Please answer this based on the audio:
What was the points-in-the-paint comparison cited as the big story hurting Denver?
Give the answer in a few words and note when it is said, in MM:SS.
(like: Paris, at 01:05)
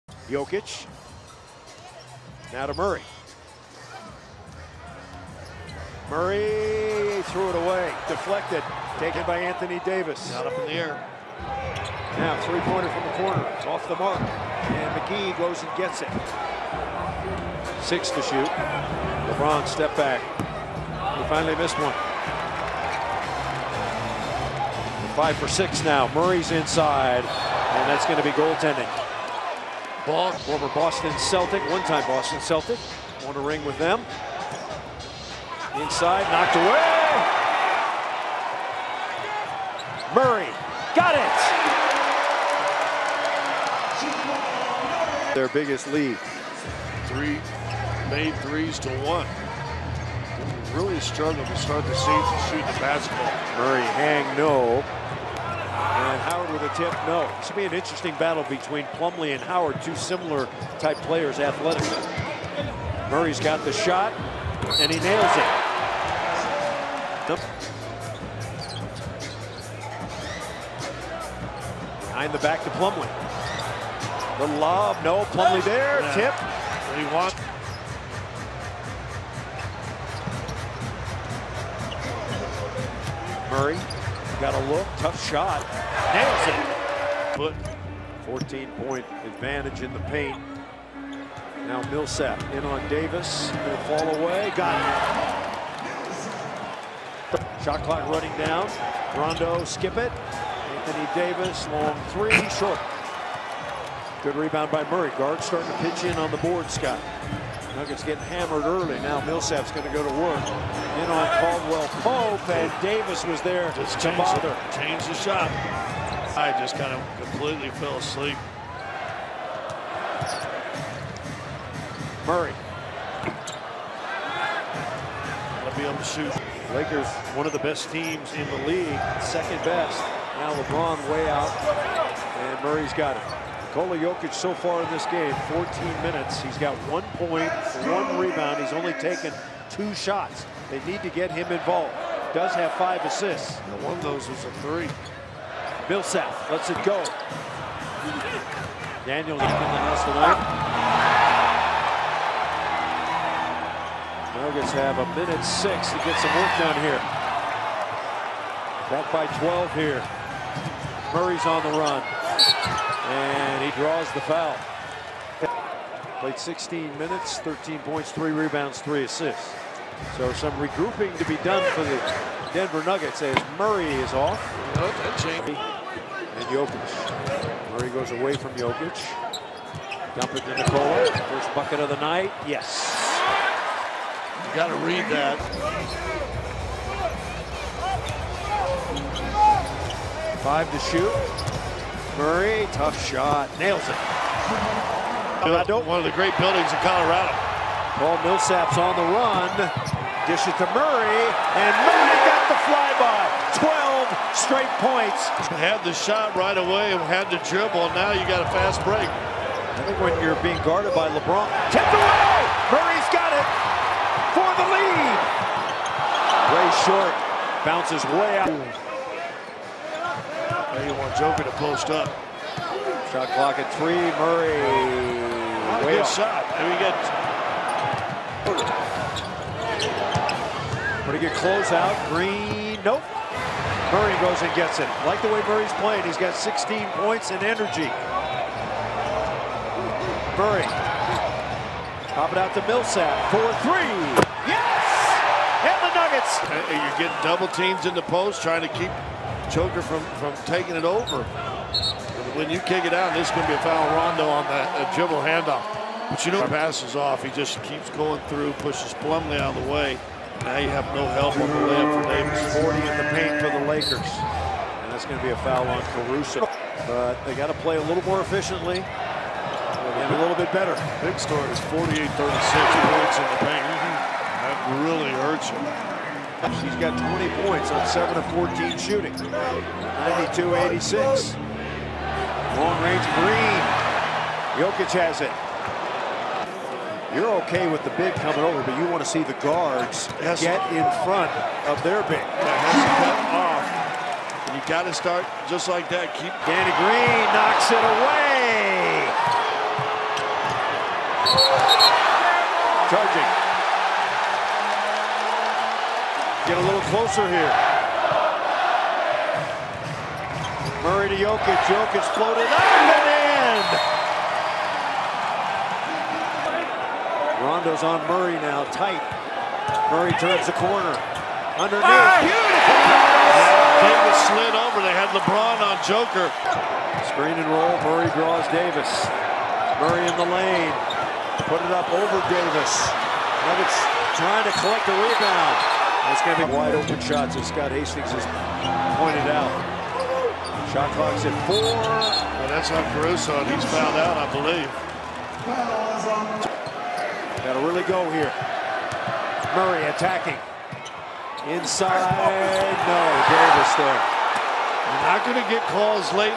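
48-36, at 04:31.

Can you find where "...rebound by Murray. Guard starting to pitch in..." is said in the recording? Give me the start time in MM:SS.
01:44.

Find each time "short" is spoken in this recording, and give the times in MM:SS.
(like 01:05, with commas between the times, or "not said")
01:42, 03:36.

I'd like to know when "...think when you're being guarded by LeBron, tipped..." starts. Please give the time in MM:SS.
03:29.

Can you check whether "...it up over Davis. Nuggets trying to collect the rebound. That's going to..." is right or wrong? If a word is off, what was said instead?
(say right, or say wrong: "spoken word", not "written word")
right.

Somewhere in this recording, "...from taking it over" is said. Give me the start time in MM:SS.
04:10.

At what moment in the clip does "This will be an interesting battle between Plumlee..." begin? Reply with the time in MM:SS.
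00:57.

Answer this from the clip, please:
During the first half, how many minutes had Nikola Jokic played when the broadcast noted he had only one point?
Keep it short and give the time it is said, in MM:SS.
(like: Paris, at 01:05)
14, at 02:15.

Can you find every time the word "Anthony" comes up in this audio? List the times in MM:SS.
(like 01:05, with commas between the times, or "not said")
00:09, 01:40.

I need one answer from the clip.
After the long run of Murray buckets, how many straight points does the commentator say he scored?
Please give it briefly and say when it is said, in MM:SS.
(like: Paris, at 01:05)
12, at 03:23.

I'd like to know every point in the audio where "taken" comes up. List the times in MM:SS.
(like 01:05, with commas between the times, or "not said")
00:08, 02:18.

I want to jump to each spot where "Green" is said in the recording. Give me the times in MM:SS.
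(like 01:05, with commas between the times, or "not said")
03:52, 04:43, 04:56.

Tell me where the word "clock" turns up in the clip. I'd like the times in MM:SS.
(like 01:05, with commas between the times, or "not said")
01:37, 03:43, 05:40.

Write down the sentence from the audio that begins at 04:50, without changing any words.
get in front of their big.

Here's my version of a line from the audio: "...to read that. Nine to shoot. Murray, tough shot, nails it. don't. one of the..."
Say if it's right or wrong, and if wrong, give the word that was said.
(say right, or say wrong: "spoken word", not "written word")
wrong: "Five", not "Nine".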